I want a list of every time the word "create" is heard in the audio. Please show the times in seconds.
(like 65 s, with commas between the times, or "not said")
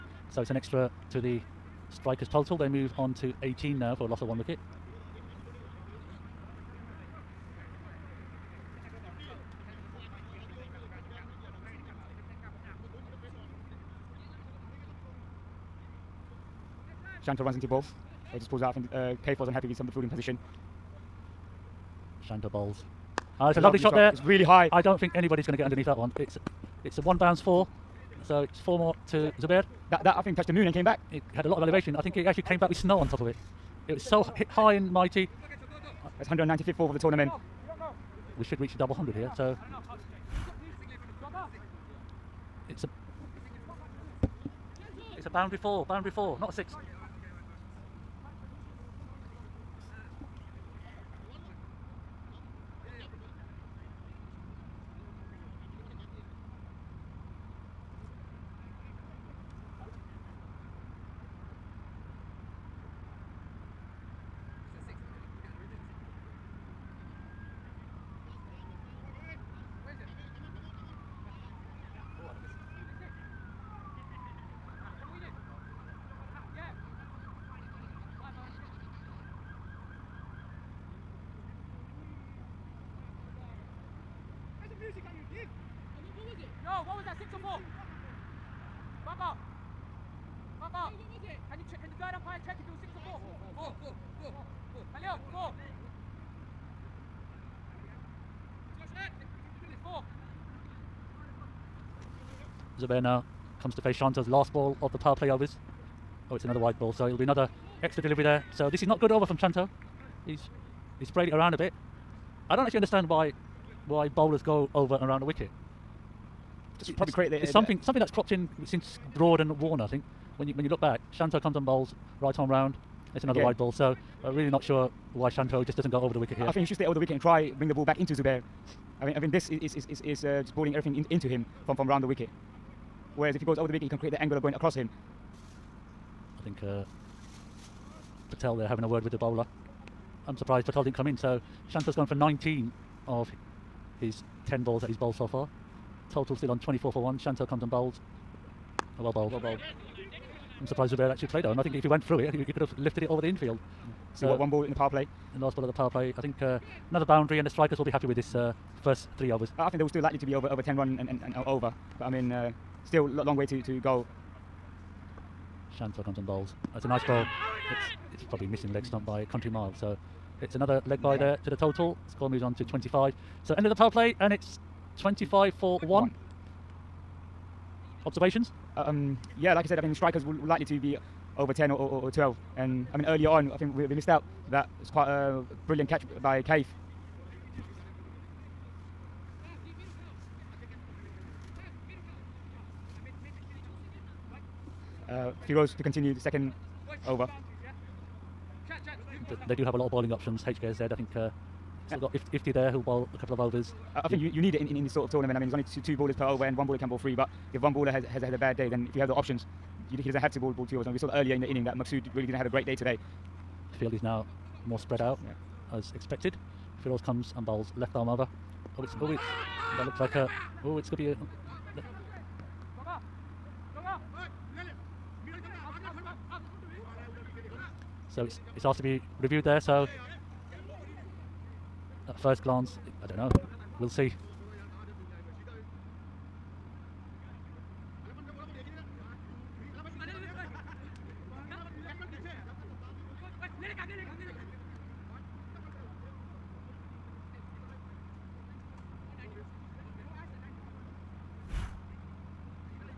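117 s, 133 s.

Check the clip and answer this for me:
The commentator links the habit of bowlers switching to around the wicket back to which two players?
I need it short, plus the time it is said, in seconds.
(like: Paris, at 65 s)
Broad and Warner, at 119 s.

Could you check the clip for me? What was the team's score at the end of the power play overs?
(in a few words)
25 for 1.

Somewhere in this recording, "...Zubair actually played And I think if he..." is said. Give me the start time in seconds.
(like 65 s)
150 s.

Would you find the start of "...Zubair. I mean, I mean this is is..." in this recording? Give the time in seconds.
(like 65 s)
128 s.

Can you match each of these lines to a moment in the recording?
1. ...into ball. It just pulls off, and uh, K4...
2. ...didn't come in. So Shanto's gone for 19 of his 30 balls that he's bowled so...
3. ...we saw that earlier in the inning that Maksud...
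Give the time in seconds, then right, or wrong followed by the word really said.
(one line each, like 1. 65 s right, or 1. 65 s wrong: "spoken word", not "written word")
1. 17 s right
2. 140 s wrong: "10", not "30"
3. 210 s right.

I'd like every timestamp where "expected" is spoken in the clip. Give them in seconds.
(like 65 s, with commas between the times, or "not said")
215 s.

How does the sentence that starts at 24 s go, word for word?
I don't think anybody's going to get underneath that one.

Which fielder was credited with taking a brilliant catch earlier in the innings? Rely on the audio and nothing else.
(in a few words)
Kaif.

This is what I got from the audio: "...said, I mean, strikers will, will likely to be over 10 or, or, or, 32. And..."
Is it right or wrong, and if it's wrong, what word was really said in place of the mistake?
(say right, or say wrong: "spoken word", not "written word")
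wrong: "12", not "32".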